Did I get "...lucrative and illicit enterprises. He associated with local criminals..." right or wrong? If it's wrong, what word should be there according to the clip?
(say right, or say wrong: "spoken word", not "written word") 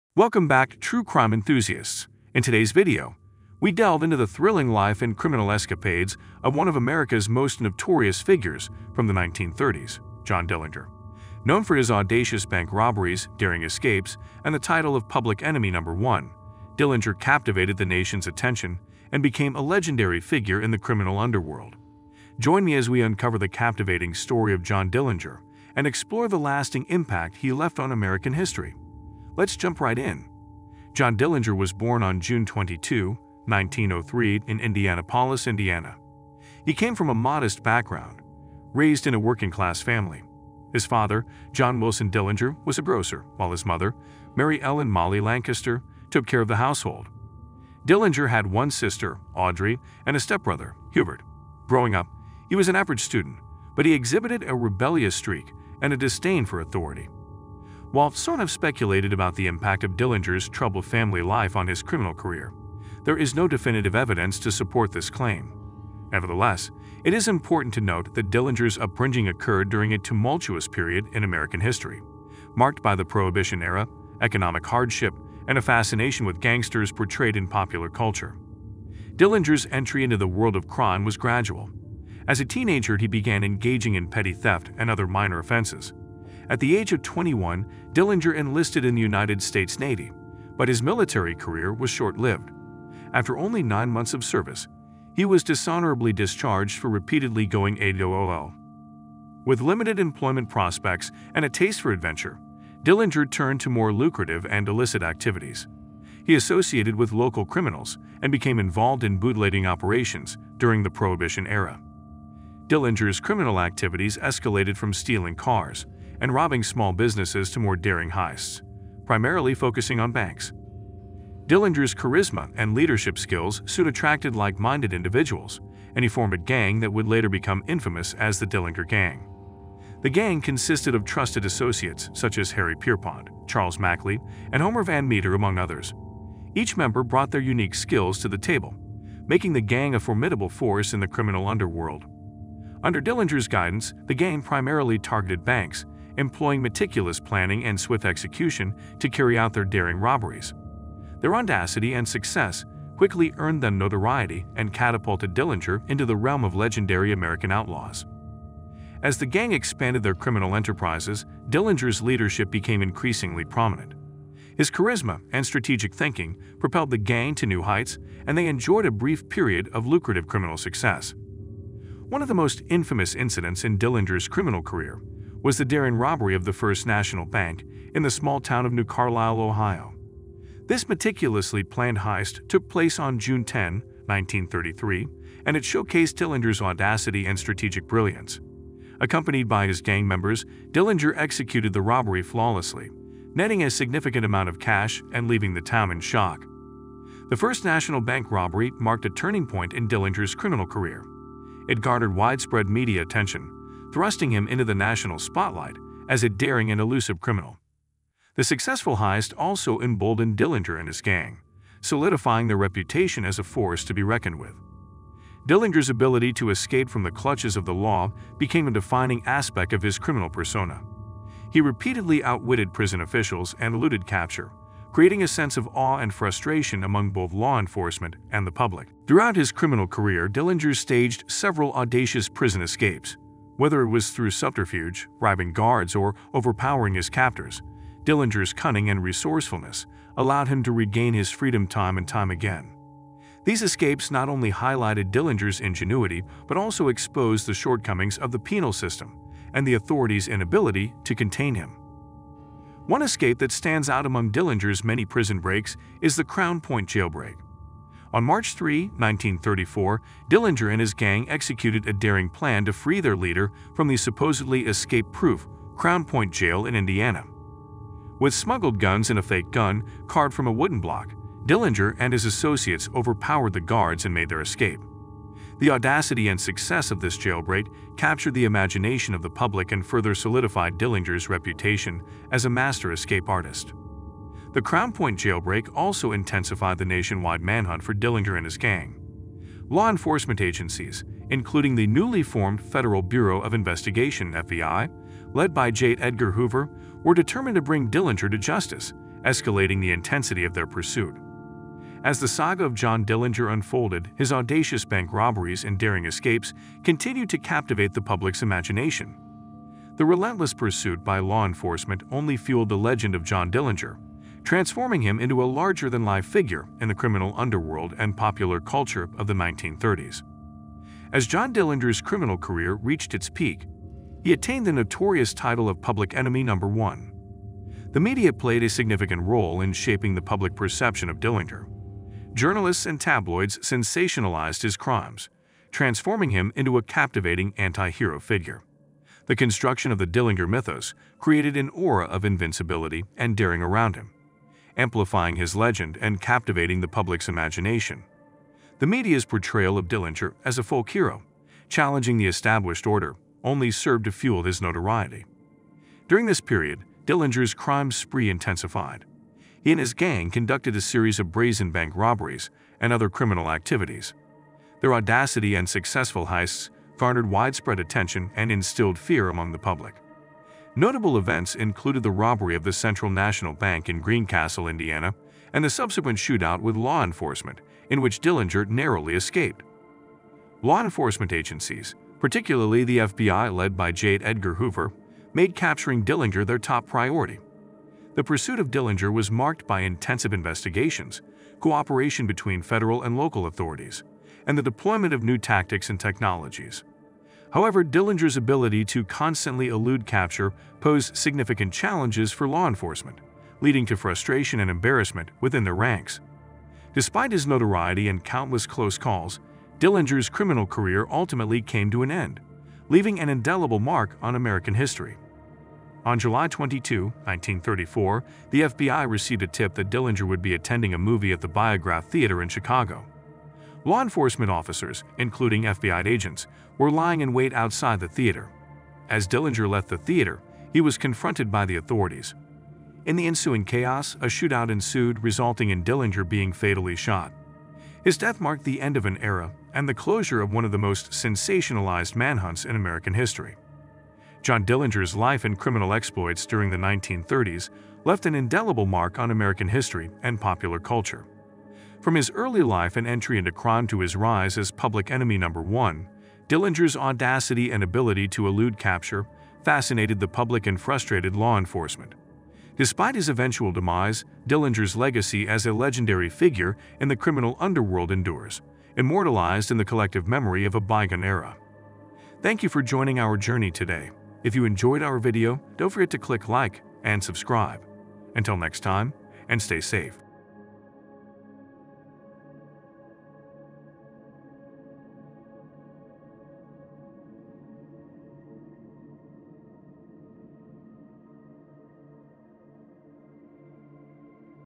wrong: "activities", not "enterprises".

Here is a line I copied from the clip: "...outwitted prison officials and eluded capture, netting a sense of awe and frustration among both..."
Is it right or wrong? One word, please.
wrong.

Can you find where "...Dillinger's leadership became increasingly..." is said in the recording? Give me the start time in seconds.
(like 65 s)
161 s.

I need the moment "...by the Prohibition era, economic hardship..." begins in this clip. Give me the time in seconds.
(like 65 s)
72 s.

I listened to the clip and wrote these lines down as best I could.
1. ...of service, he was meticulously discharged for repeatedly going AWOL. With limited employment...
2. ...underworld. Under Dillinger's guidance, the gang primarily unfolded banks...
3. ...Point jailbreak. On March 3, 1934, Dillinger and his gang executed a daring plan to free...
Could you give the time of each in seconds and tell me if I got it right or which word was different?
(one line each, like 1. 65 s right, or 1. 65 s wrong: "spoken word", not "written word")
1. 94 s wrong: "dishonorably", not "meticulously"
2. 141 s wrong: "targeted", not "unfolded"
3. 256 s right.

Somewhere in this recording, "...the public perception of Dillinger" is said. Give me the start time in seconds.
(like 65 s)
330 s.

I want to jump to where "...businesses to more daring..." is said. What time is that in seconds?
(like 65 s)
116 s.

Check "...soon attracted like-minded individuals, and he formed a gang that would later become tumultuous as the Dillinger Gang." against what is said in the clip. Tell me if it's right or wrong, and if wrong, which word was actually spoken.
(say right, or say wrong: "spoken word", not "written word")
wrong: "infamous", not "tumultuous".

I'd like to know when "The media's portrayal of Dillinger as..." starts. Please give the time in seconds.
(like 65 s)
348 s.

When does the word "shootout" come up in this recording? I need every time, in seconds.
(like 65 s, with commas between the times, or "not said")
376 s, 434 s.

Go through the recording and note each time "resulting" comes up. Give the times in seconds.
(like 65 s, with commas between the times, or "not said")
435 s.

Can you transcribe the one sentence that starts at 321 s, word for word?
As John Dillinger's criminal career reached its peak, he attained the notorious title of Public Enemy Number 1.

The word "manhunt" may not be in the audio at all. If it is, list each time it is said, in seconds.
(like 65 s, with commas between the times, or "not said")
287 s, 442 s.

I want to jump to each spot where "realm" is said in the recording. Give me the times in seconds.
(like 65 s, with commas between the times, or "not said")
156 s.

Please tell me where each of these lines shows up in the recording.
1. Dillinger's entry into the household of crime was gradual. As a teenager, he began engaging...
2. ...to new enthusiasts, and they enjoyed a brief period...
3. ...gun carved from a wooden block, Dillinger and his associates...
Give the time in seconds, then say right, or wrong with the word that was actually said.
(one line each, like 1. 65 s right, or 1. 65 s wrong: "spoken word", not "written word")
1. 79 s wrong: "world", not "household"
2. 167 s wrong: "heights", not "enthusiasts"
3. 269 s right.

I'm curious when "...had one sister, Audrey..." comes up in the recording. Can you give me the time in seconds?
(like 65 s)
48 s.